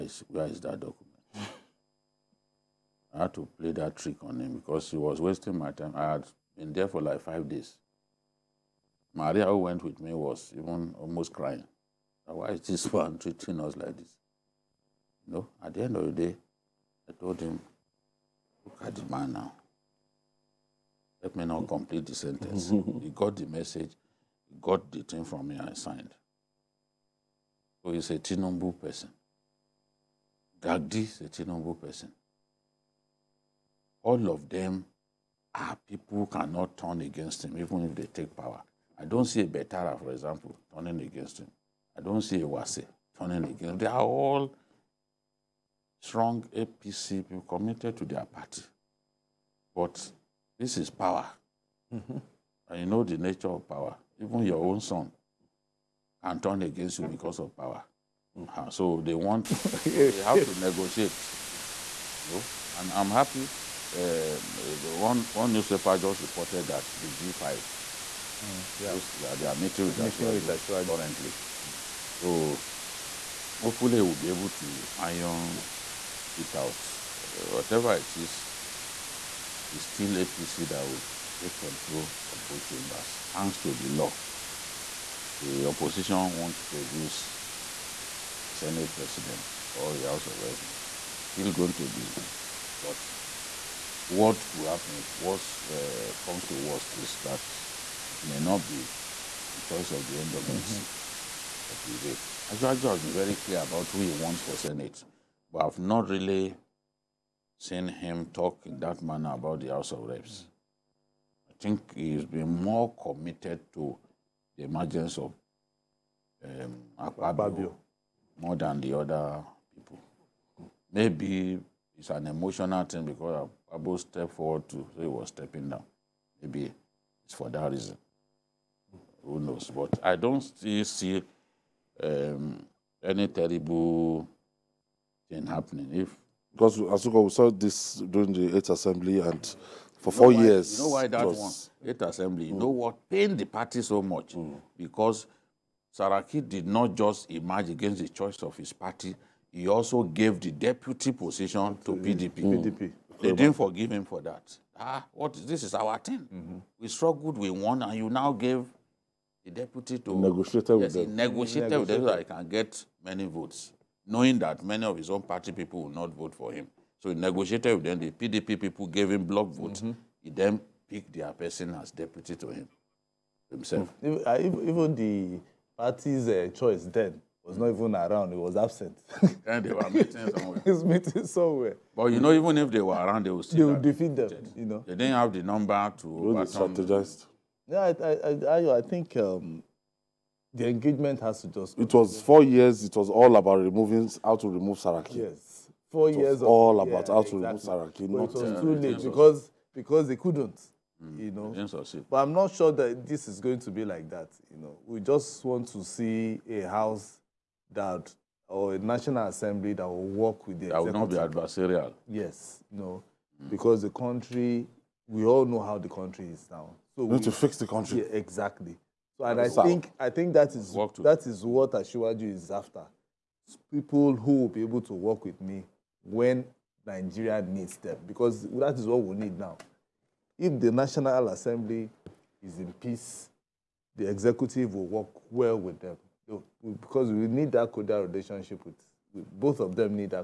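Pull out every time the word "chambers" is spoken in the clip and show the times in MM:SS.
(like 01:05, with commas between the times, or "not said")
01:22.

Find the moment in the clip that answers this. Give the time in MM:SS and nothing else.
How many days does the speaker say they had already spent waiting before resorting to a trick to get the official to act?
00:07.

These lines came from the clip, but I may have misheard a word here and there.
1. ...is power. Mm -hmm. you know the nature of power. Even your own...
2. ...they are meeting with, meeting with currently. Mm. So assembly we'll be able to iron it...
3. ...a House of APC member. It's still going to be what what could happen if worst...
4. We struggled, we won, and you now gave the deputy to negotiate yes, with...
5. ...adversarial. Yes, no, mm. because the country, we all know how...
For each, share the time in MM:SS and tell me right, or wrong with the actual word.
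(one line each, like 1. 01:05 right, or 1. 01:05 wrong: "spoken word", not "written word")
1. 00:50 right
2. 01:09 wrong: "hopefully", not "assembly"
3. 01:29 wrong: "Reps", not "APC"
4. 02:36 right
5. 03:31 right.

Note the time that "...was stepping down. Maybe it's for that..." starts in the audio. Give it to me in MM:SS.
02:05.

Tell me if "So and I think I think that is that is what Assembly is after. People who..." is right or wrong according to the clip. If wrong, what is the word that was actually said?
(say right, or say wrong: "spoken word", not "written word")
wrong: "Ashiwaju", not "Assembly".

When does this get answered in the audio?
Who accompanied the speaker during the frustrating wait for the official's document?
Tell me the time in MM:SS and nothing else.
00:09.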